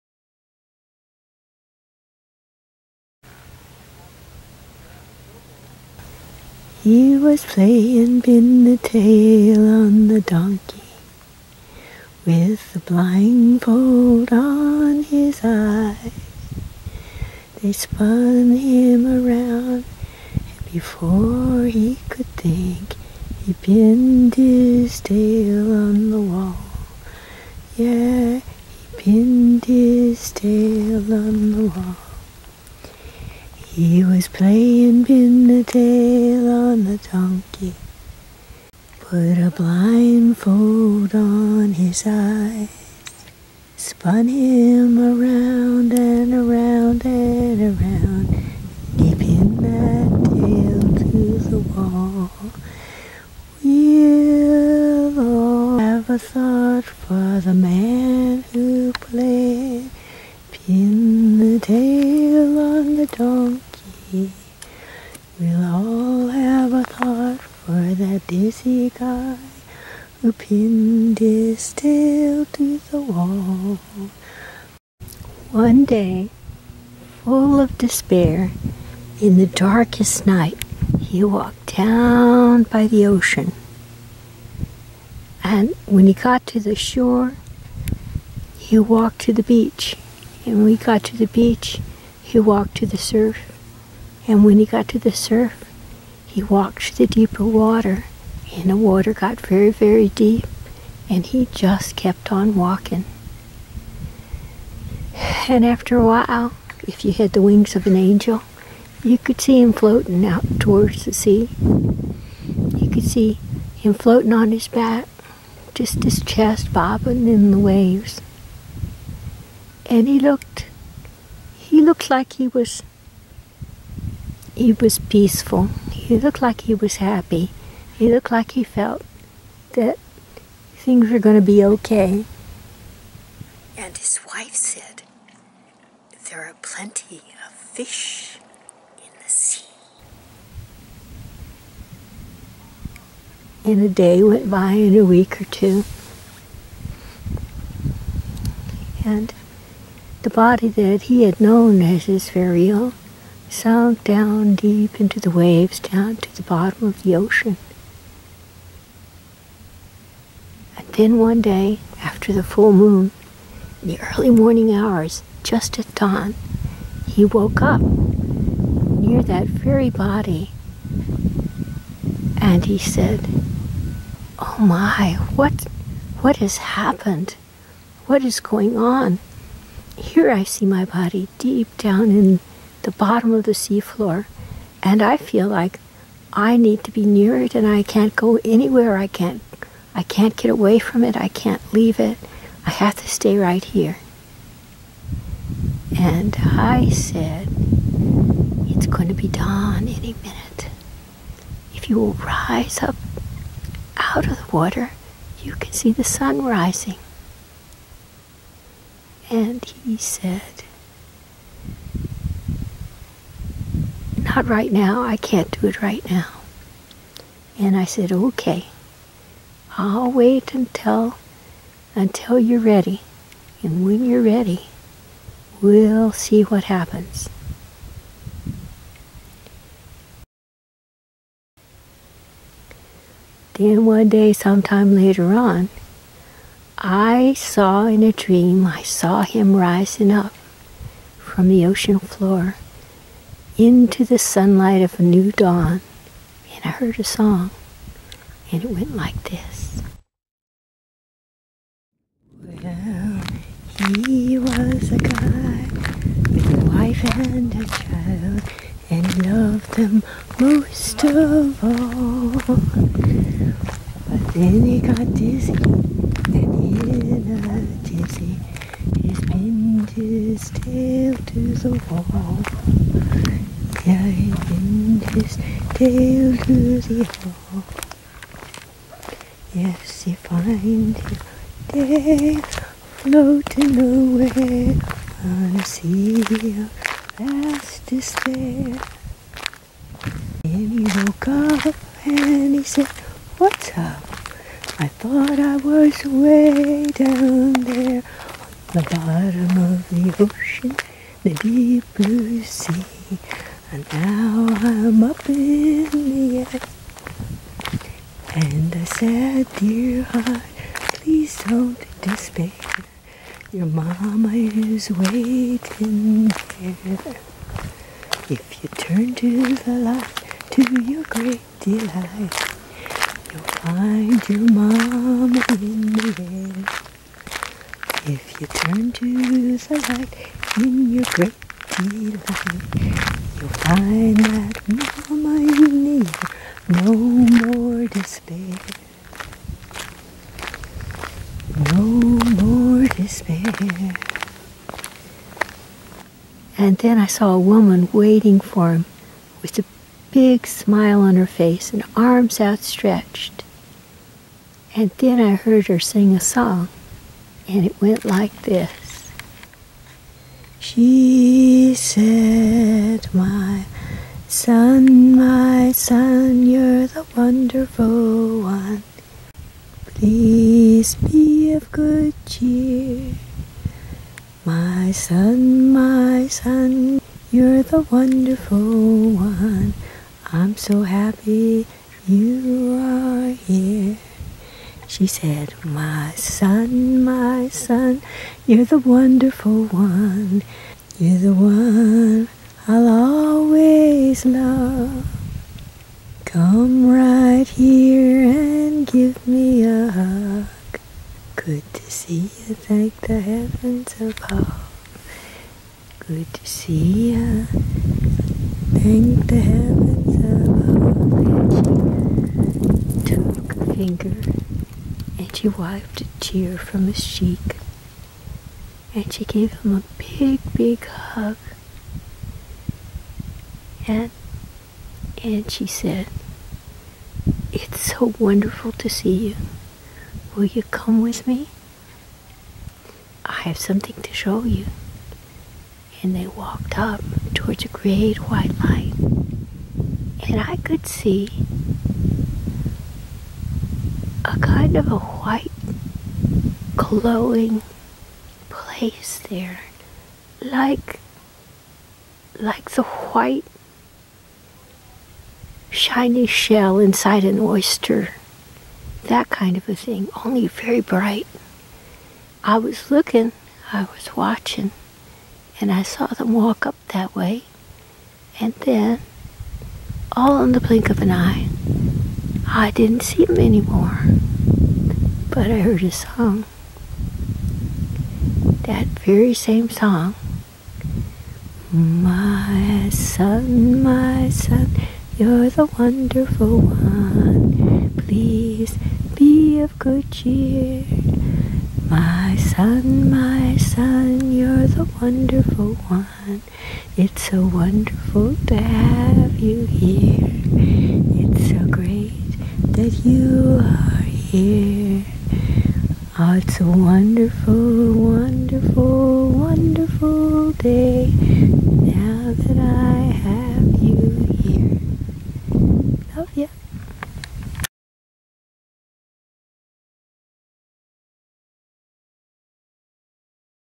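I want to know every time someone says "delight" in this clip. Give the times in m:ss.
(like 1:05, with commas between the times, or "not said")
5:21, 5:31.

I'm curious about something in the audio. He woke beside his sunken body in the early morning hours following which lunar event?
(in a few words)
The full moon.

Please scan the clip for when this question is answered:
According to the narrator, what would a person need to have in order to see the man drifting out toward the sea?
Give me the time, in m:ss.
1:47.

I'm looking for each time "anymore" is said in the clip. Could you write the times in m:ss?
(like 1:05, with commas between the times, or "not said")
7:53.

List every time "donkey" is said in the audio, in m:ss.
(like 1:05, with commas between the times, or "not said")
0:10, 0:37, 1:03.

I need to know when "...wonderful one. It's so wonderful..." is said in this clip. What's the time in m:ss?
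8:15.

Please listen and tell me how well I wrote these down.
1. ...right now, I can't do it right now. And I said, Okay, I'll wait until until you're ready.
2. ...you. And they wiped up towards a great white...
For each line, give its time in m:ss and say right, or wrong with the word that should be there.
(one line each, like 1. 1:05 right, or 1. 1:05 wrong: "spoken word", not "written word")
1. 3:34 right
2. 7:14 wrong: "walked", not "wiped".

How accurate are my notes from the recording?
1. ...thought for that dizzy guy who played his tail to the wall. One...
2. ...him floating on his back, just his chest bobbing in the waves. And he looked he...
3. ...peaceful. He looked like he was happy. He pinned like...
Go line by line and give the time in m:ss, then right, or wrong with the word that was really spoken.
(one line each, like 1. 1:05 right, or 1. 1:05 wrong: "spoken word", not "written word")
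1. 1:06 wrong: "pinned", not "played"
2. 1:53 right
3. 2:04 wrong: "looked", not "pinned".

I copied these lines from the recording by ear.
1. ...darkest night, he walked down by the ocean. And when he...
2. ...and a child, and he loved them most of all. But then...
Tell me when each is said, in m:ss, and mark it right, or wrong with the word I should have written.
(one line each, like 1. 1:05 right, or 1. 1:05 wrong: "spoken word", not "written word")
1. 1:19 right
2. 4:17 right.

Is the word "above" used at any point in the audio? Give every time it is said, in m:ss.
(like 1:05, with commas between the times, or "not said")
6:44, 6:53.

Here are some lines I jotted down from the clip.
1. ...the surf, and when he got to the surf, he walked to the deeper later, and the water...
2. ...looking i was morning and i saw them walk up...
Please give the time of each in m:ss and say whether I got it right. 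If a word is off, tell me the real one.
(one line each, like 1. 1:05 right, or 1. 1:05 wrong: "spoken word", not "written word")
1. 1:32 wrong: "water", not "later"
2. 7:42 wrong: "watching", not "morning".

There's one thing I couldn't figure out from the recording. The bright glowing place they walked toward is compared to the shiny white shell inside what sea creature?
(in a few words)
An oyster.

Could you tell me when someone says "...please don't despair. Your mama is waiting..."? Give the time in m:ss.
5:10.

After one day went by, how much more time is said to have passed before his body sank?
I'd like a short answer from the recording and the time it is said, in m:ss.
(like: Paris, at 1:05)
A week or two, at 2:24.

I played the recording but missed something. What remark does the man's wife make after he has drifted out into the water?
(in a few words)
There are plenty of fish in the sea.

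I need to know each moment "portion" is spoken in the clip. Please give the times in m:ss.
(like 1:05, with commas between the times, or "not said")
not said.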